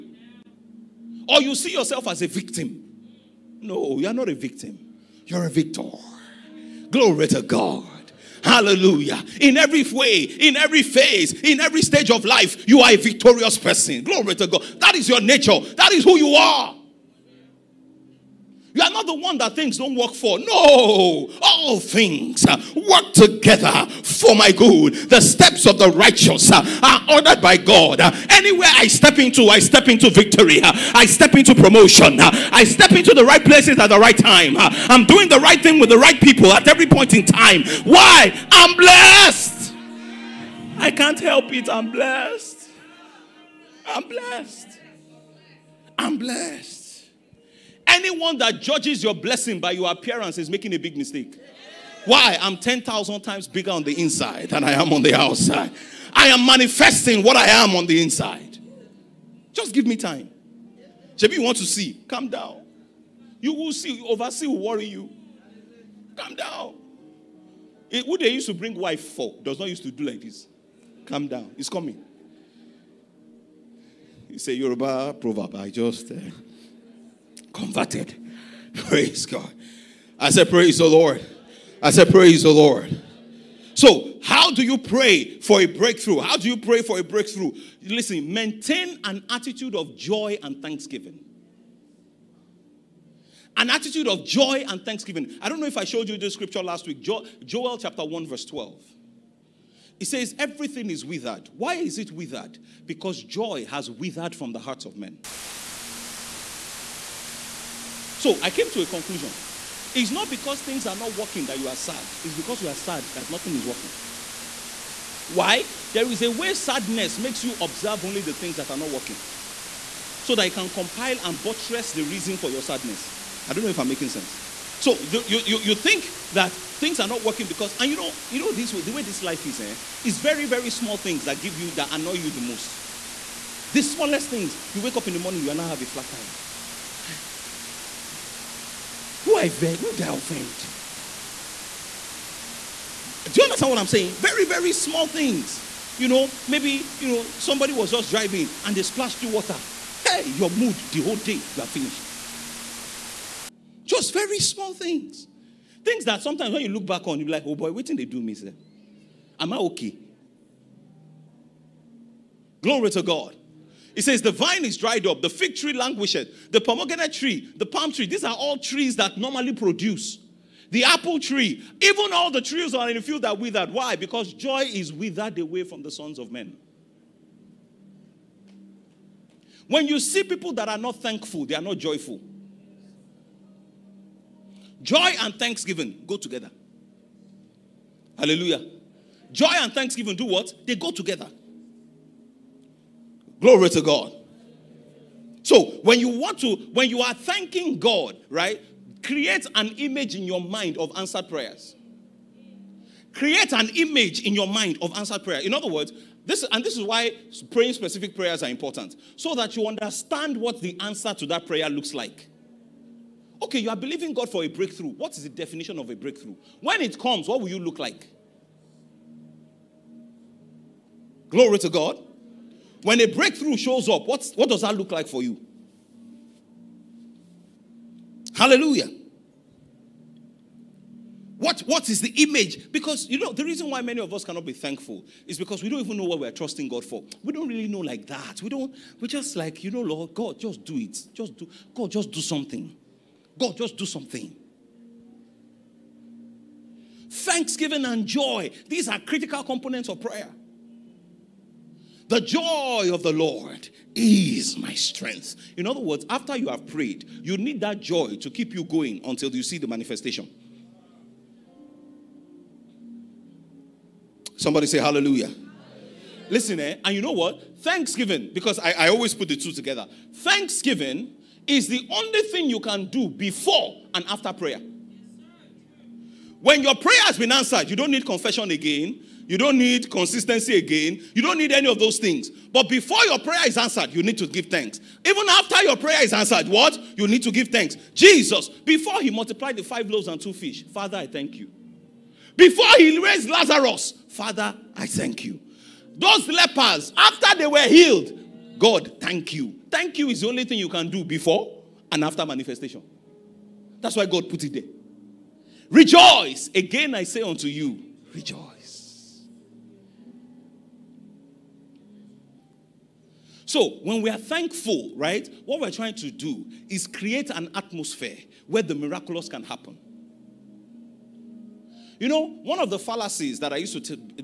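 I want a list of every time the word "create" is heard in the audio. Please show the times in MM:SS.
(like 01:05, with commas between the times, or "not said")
03:19, 03:23, 05:16.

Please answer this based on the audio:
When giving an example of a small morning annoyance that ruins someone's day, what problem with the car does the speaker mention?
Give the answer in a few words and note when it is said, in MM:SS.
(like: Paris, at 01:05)
Flat tire, at 02:15.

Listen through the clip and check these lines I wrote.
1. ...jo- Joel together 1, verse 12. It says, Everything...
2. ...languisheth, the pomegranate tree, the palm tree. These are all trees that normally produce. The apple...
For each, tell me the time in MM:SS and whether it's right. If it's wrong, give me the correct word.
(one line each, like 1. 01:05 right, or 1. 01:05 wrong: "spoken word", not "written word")
1. 01:37 wrong: "chapter", not "together"
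2. 02:45 right.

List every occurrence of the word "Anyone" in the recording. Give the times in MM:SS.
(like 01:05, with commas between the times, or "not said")
00:47.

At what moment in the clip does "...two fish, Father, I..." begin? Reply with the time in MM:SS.
04:50.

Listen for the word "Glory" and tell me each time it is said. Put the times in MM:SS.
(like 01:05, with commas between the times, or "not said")
00:06, 00:14, 02:42, 03:13, 03:41.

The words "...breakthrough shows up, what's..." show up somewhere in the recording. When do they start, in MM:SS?
03:43.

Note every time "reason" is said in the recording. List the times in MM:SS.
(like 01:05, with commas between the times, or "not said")
02:02, 03:53.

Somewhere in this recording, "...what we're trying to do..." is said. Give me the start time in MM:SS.
05:15.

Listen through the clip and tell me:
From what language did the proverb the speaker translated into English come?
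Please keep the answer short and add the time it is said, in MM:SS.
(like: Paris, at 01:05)
Yoruba, at 01:14.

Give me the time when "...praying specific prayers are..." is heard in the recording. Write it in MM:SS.
03:27.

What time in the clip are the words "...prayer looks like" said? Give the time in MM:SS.
03:31.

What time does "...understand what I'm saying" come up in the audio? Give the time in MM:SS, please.
02:23.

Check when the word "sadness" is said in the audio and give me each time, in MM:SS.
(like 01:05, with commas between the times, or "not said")
01:56, 02:02.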